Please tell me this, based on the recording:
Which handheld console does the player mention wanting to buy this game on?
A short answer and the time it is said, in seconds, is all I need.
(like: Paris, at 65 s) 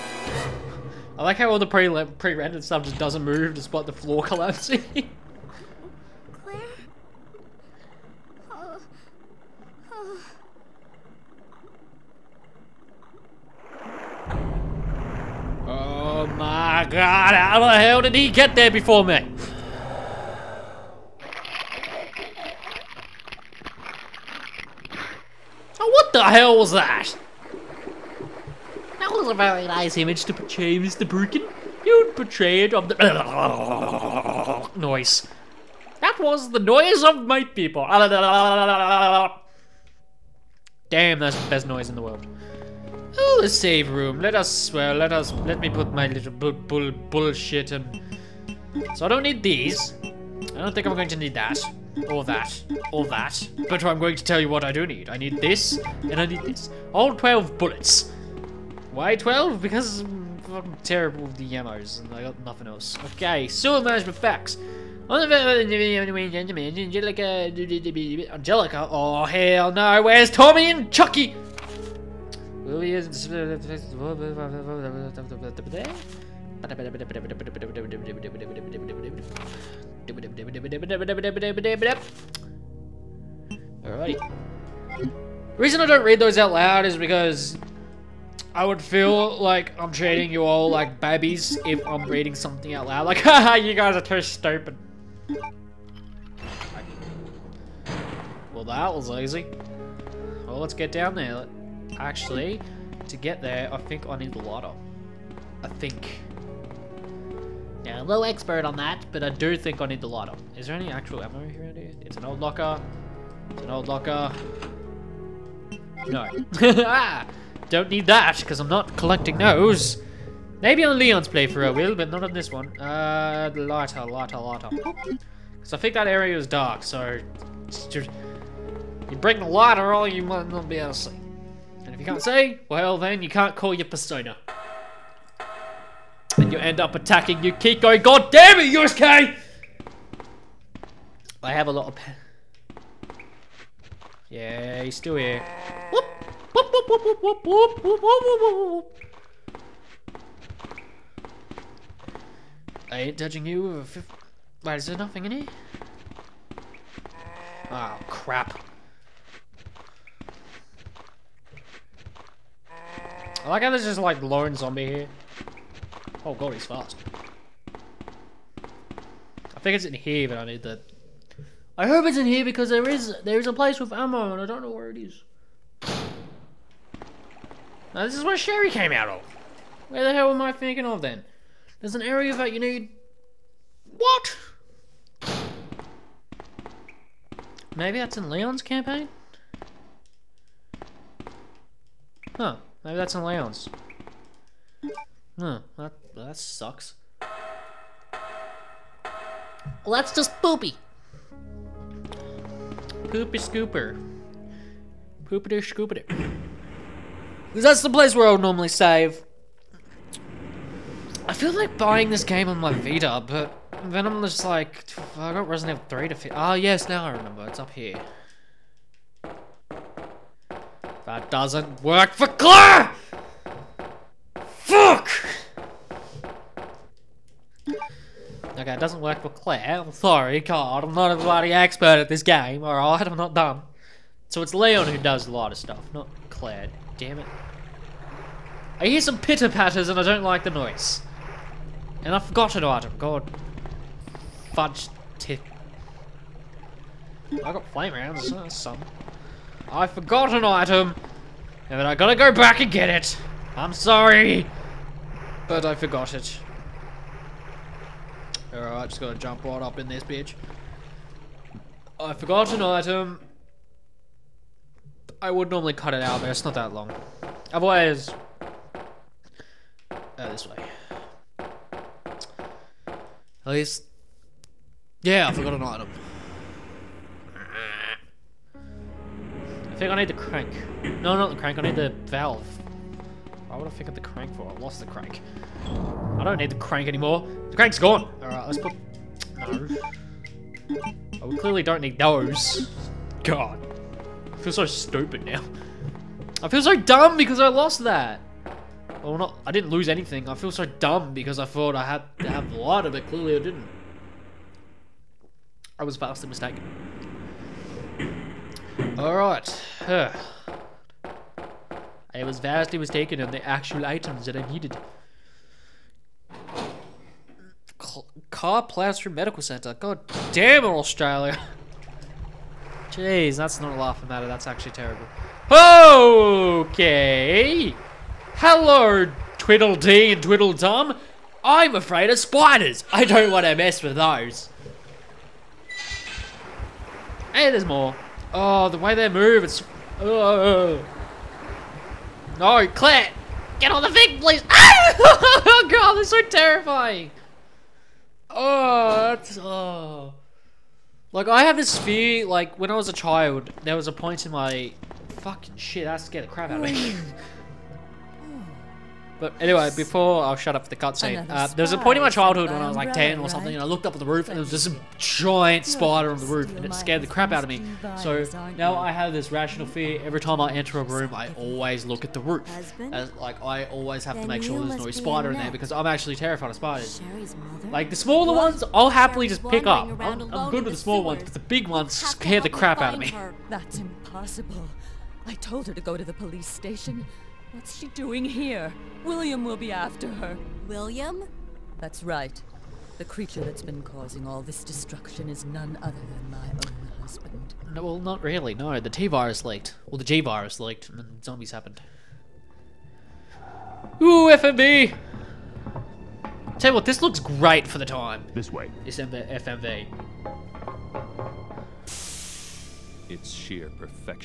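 Vita, at 212 s.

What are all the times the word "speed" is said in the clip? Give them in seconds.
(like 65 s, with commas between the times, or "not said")
not said.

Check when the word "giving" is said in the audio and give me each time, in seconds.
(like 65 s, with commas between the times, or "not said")
not said.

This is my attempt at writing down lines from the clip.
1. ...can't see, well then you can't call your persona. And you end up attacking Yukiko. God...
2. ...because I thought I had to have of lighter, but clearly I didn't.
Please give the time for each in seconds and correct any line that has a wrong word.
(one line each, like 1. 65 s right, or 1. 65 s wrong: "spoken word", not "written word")
1. 132 s right
2. 301 s right.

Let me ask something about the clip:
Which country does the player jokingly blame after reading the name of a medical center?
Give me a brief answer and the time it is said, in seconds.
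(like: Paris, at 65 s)
Australia, at 320 s.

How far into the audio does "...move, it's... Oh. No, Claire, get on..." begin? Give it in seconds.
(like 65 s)
339 s.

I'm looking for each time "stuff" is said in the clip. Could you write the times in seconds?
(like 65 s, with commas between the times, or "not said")
2 s, 235 s.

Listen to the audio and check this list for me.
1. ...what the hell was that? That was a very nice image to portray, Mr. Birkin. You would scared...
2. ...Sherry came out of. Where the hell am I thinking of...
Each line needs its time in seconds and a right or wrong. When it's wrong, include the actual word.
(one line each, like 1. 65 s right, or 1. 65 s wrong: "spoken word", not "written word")
1. 25 s wrong: "portrayed", not "scared"
2. 178 s right.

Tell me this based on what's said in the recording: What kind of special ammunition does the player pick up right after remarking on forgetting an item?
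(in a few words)
flame rounds.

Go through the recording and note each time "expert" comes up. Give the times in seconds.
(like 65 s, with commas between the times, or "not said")
108 s, 231 s.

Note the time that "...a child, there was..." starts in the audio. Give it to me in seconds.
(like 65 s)
352 s.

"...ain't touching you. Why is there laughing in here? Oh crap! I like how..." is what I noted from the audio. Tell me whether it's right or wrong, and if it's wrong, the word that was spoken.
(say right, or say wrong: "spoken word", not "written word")
wrong: "nothing", not "laughing".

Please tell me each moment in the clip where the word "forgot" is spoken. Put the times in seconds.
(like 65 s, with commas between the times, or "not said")
242 s, 249 s, 255 s, 262 s, 275 s.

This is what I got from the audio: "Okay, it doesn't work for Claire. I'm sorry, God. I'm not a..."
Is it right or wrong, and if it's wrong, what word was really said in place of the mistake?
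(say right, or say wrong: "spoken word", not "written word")
right.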